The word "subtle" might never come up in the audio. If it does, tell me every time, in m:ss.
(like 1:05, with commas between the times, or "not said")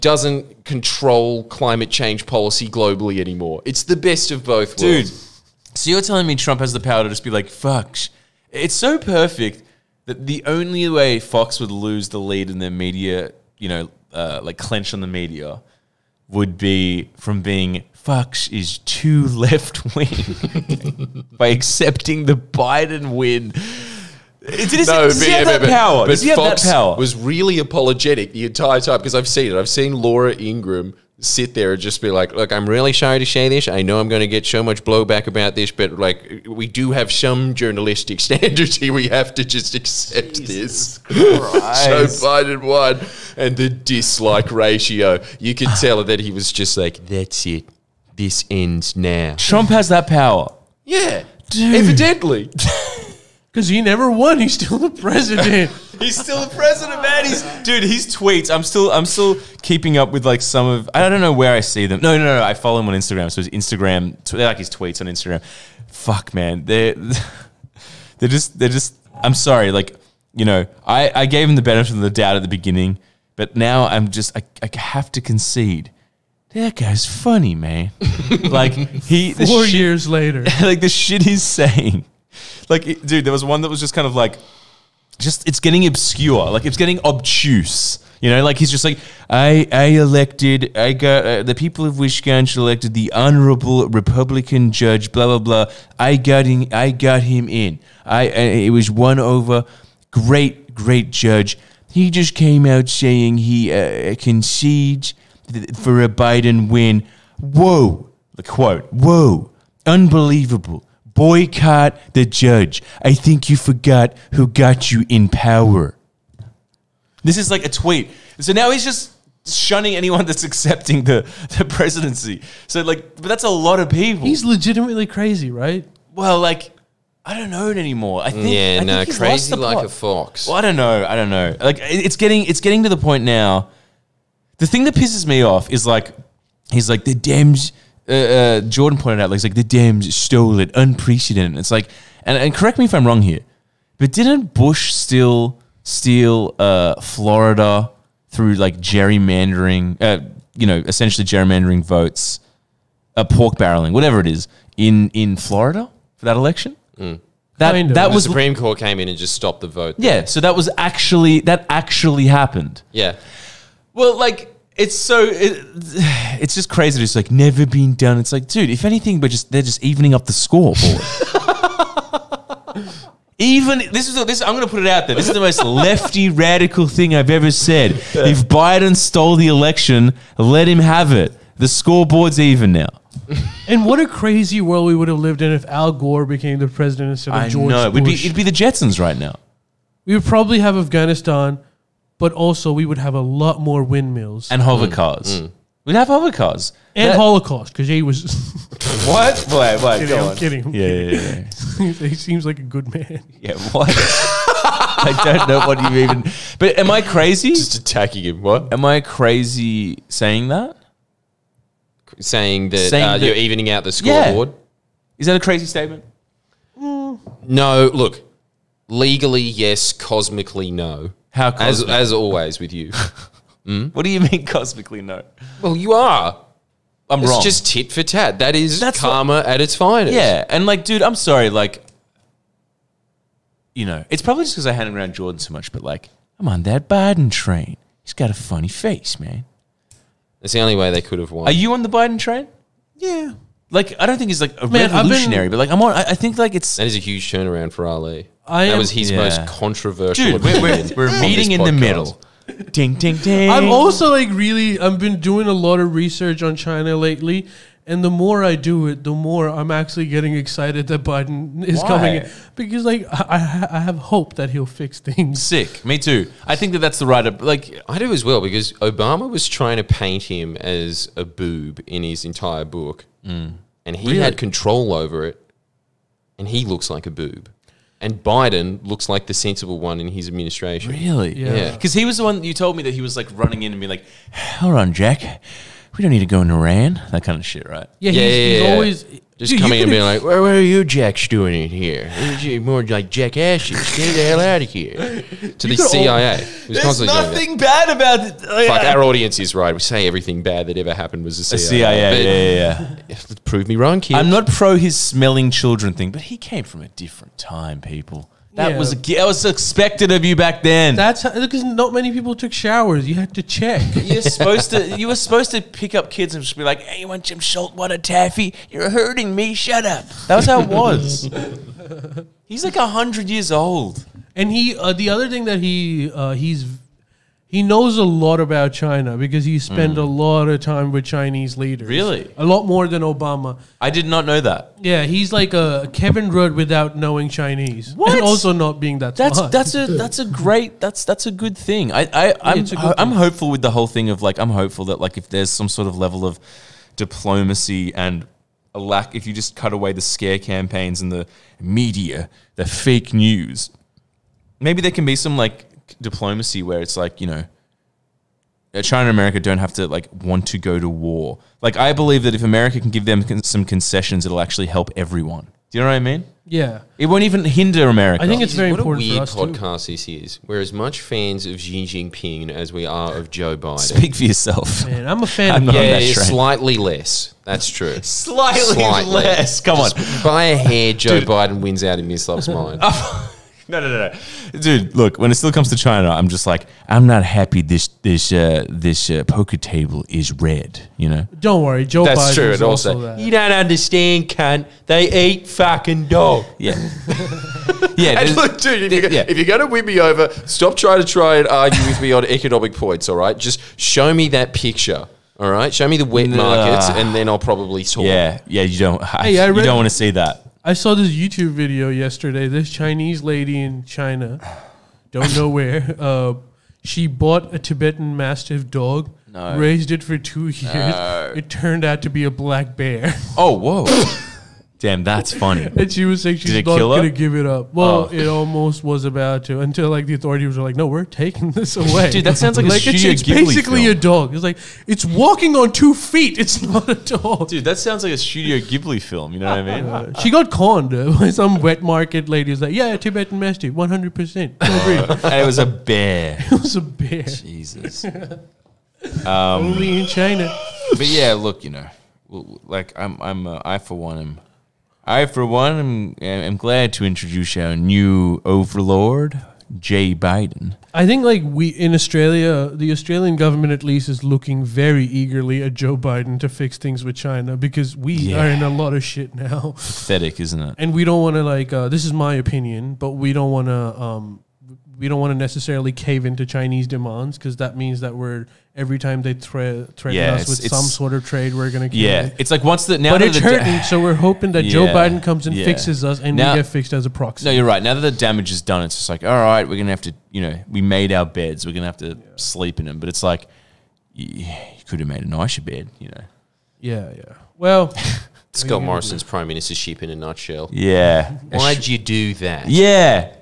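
not said.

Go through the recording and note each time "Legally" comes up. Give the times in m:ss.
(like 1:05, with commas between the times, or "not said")
3:38.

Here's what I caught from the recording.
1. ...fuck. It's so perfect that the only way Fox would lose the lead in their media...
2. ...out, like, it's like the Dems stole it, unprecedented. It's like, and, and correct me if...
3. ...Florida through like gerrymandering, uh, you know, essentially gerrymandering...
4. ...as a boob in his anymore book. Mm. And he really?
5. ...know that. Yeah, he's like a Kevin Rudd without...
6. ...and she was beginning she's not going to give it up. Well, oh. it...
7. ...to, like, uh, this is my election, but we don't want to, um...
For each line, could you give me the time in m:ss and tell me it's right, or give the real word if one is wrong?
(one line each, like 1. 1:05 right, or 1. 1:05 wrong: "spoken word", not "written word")
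1. 0:07 right
2. 2:19 right
3. 2:27 right
4. 4:30 wrong: "entire", not "anymore"
5. 5:34 right
6. 7:05 wrong: "saying", not "beginning"
7. 7:51 wrong: "opinion", not "election".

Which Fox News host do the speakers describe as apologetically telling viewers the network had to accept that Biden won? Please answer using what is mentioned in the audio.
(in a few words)
Laura Ingraham.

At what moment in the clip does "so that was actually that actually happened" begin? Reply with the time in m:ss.
2:40.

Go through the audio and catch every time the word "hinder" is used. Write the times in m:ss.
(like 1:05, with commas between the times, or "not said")
6:07.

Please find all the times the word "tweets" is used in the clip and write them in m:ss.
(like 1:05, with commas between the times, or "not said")
0:58, 1:04, 1:57.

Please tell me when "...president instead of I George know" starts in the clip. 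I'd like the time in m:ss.
3:06.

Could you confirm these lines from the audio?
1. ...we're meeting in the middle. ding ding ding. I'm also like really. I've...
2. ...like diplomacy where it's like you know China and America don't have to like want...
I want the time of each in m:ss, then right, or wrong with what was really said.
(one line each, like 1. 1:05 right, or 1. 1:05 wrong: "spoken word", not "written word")
1. 4:10 right
2. 5:55 right.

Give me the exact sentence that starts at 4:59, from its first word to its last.
We say everything bad that ever happened was the CIA.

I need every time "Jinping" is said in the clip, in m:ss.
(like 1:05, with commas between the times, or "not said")
6:11.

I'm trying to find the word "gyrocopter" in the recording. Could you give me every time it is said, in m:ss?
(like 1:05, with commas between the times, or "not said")
not said.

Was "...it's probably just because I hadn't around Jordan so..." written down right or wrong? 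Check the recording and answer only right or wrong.
right.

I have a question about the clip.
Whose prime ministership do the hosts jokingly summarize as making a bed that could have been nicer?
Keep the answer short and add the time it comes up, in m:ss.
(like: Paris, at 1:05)
Scott Morrison, at 8:18.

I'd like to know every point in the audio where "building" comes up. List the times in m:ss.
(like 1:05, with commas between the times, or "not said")
not said.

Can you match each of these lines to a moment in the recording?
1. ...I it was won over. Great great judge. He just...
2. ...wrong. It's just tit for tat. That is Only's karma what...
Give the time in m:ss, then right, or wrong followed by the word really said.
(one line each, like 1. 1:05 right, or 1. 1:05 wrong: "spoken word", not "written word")
1. 1:38 right
2. 3:47 wrong: "That", not "Only".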